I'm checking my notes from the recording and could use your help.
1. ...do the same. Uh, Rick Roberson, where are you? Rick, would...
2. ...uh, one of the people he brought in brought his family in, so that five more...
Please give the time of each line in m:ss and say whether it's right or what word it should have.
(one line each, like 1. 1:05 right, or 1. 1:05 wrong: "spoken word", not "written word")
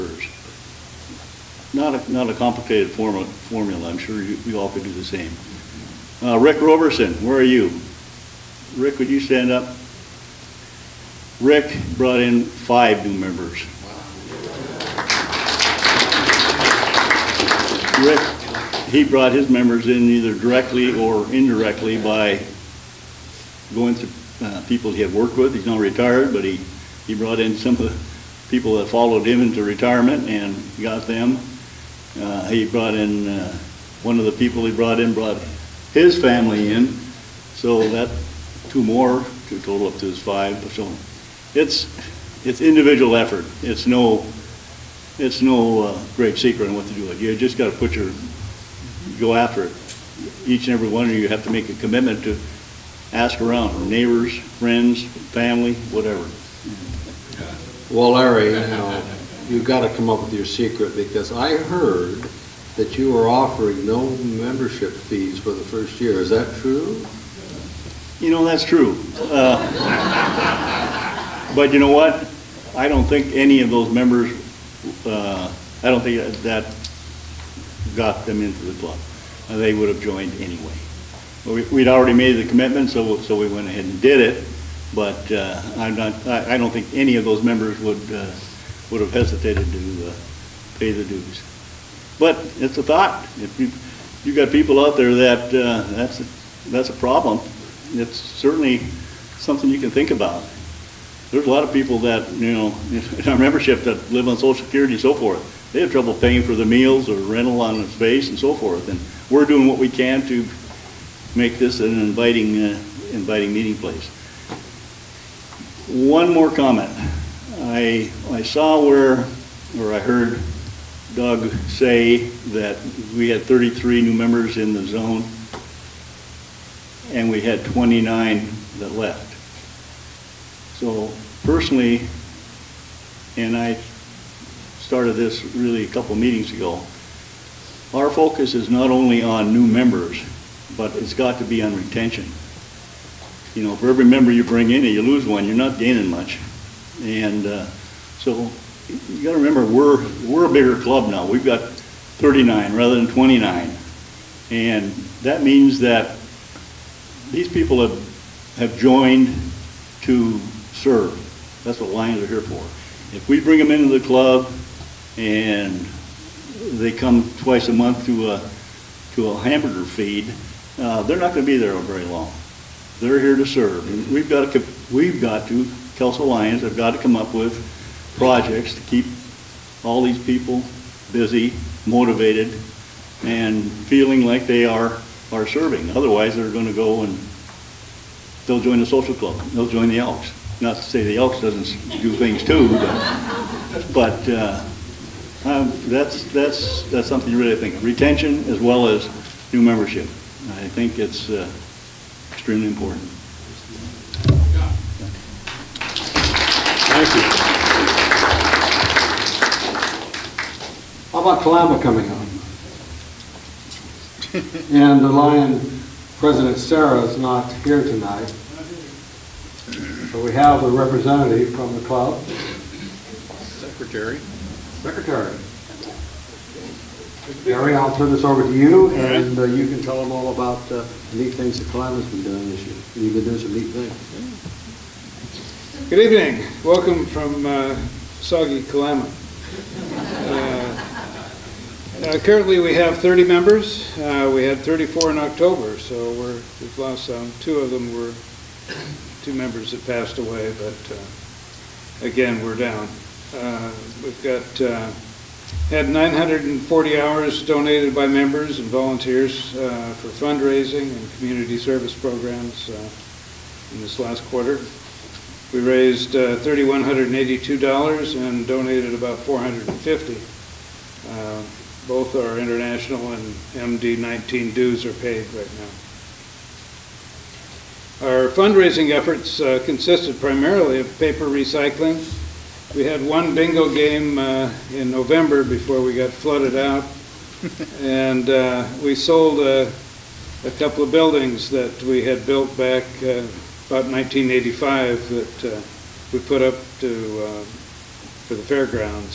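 1. 0:04 right
2. 0:33 wrong: "two", not "five".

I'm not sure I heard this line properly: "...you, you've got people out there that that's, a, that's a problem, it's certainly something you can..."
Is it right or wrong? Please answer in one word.
right.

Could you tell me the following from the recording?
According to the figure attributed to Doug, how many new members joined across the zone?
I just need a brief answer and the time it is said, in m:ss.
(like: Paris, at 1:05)
33, at 2:03.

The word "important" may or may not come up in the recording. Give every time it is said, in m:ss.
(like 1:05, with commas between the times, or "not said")
3:22.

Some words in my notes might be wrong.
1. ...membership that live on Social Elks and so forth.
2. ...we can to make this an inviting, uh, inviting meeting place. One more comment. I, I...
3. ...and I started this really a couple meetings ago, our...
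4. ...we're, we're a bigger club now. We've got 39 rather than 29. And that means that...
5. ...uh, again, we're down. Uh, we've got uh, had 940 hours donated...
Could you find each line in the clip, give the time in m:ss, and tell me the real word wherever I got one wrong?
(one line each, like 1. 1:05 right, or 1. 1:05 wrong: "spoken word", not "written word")
1. 1:43 wrong: "Security", not "Elks"
2. 1:49 right
3. 2:13 right
4. 2:29 right
5. 4:10 right.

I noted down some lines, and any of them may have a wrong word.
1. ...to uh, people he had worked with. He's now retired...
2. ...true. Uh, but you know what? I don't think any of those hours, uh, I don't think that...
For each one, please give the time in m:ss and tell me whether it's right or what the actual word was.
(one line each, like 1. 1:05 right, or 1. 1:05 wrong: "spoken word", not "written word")
1. 0:23 right
2. 1:08 wrong: "members", not "hours".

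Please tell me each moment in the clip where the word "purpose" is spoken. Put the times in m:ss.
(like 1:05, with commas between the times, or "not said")
not said.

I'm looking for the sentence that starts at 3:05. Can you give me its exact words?
Otherwise, they're going to go and they'll join the social club.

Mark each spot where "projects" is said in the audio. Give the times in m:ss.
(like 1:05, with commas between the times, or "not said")
2:58.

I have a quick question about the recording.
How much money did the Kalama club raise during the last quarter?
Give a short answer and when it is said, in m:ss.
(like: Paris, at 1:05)
$3,182, at 4:26.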